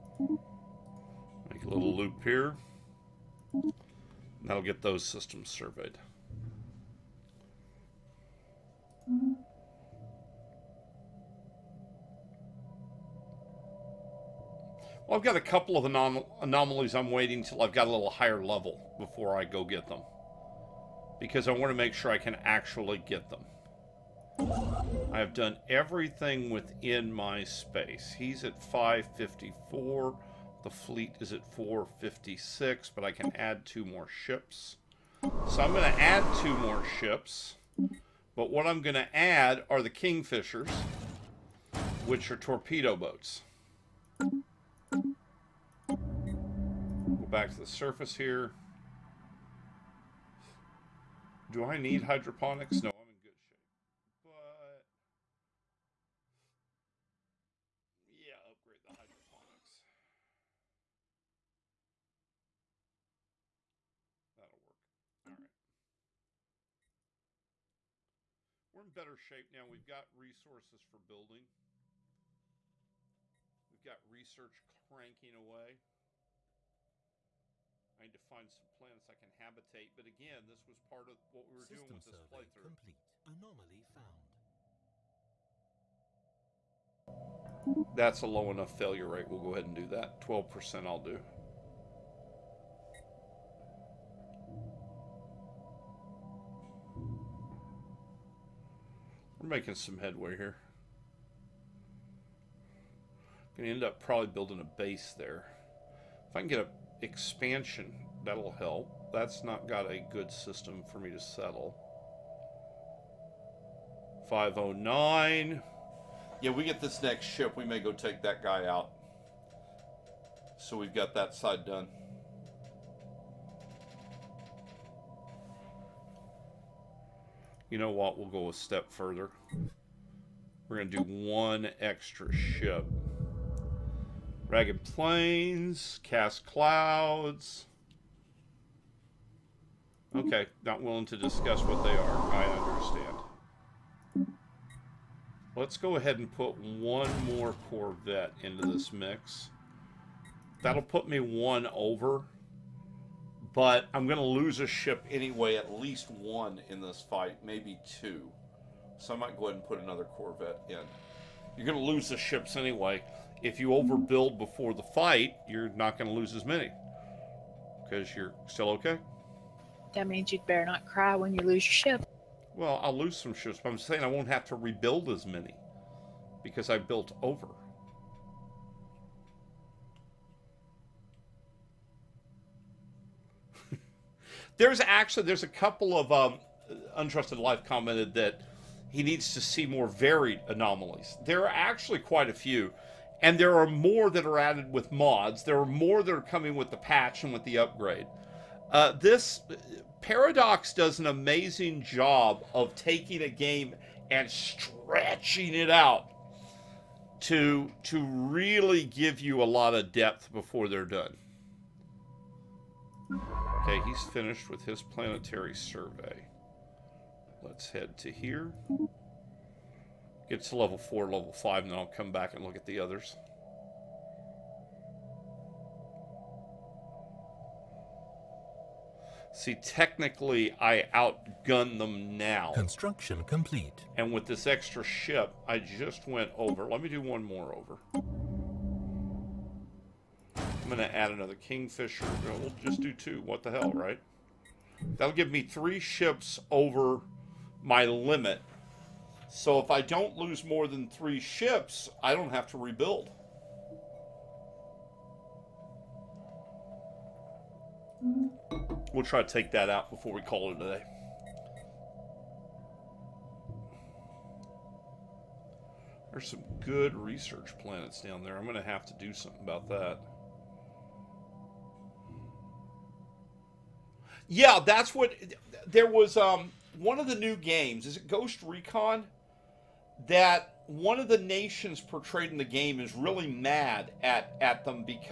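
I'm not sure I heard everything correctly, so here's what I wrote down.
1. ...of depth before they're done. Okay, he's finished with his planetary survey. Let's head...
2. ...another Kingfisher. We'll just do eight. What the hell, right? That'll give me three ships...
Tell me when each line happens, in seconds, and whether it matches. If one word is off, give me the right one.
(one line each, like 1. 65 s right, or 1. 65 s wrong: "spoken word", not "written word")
1. 209 s right
2. 241 s wrong: "two", not "eight".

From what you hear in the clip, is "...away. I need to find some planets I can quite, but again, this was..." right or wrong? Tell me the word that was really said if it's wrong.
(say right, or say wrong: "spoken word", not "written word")
wrong: "habitate", not "quite".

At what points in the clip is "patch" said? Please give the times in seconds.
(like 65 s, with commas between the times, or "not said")
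196 s.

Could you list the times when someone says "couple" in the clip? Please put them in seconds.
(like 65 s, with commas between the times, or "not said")
15 s, 185 s.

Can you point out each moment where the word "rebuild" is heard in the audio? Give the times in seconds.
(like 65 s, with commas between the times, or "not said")
174 s, 252 s.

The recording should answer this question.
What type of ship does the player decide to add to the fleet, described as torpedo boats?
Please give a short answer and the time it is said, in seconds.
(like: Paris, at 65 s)
Kingfishers, at 39 s.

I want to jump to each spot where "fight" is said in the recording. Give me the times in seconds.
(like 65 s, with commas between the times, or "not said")
157 s, 164 s.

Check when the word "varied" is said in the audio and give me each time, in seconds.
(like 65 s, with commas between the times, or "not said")
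189 s.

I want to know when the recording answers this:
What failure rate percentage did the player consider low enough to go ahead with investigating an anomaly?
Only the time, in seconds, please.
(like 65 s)
90 s.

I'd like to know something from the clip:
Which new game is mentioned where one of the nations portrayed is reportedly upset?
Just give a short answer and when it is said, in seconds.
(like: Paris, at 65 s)
Ghost Recon, at 278 s.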